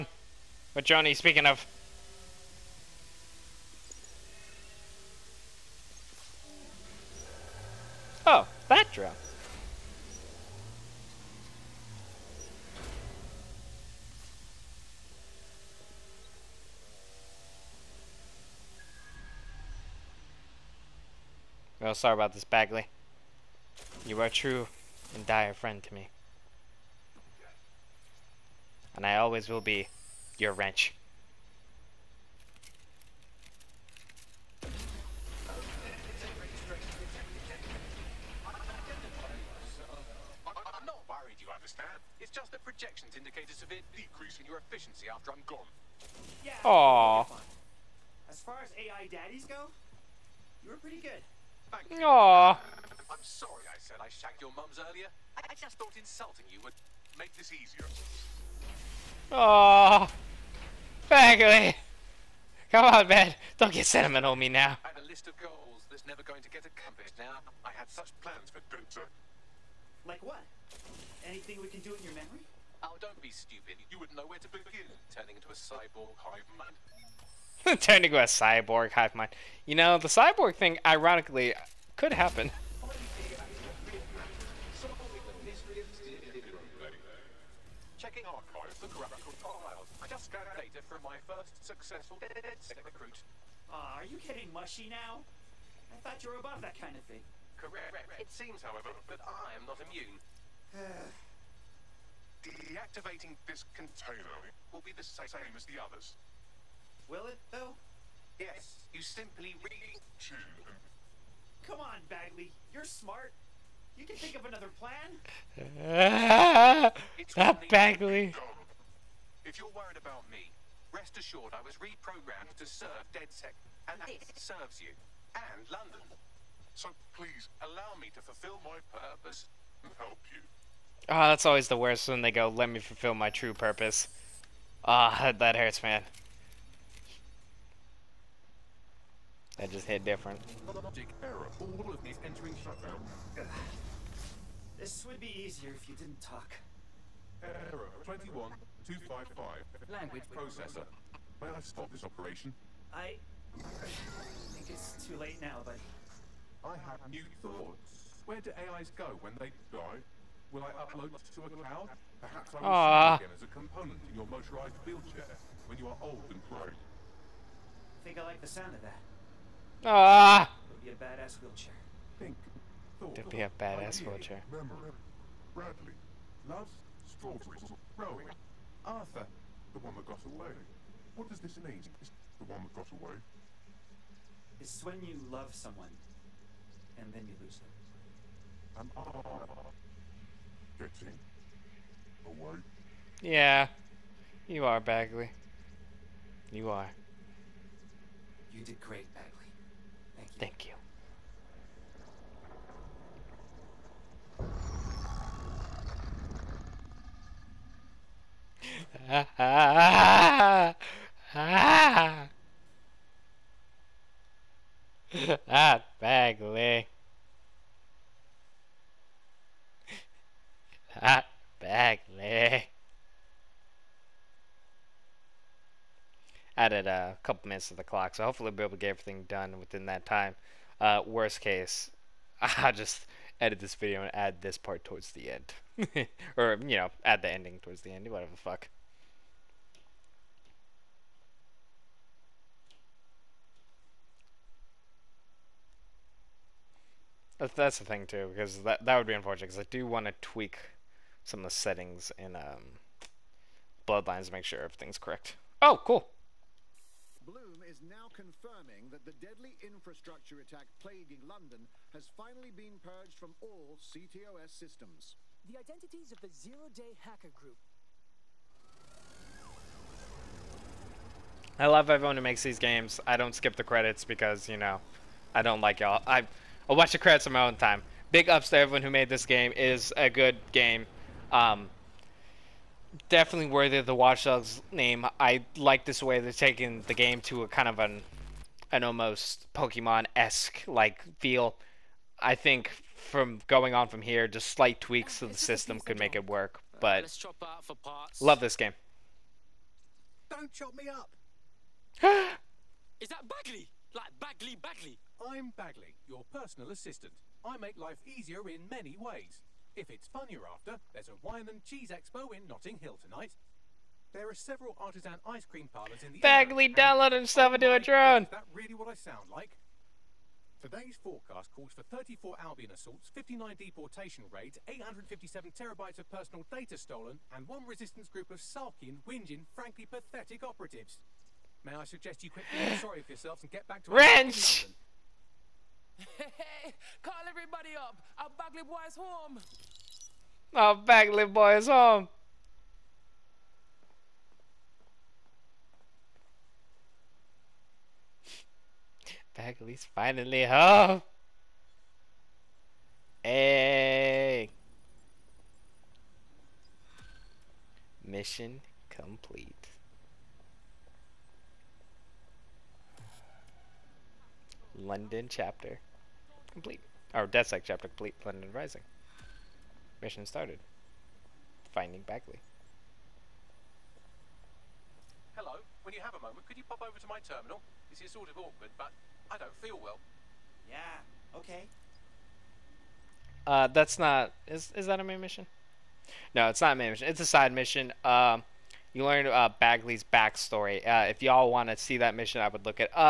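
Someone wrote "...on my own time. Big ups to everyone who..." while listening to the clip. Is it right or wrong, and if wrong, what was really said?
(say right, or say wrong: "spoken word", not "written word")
right.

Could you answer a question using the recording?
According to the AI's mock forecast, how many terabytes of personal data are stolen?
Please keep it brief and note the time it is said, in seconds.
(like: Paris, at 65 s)
857, at 324 s.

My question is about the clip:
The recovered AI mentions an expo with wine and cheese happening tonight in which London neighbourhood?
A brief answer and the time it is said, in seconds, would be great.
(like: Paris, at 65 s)
Notting Hill, at 312 s.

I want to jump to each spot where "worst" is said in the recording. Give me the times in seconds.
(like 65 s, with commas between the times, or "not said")
131 s, 231 s.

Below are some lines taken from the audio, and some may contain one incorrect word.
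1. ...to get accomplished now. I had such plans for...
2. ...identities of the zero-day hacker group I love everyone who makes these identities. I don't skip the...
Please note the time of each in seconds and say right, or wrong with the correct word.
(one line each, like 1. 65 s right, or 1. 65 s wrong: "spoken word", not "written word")
1. 66 s right
2. 265 s wrong: "games", not "identities".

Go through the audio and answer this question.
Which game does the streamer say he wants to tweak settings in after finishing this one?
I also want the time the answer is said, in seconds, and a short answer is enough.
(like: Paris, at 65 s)
Bloodlines, at 253 s.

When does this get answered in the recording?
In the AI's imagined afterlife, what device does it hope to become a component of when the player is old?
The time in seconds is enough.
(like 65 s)
164 s.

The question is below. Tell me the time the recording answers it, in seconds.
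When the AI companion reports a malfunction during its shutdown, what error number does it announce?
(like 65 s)
147 s.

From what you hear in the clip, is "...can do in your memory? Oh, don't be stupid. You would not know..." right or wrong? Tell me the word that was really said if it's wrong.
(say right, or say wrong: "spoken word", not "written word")
right.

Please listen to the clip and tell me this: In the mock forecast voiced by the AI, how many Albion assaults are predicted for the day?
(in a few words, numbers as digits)
34.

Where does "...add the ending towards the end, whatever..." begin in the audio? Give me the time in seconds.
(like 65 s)
237 s.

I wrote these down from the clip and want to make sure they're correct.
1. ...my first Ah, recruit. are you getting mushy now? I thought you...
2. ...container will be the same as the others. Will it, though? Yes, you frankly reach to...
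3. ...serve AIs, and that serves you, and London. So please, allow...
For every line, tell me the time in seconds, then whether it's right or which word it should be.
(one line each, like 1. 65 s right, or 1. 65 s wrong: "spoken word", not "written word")
1. 91 s right
2. 103 s wrong: "simply", not "frankly"
3. 122 s wrong: "DedSec", not "AIs".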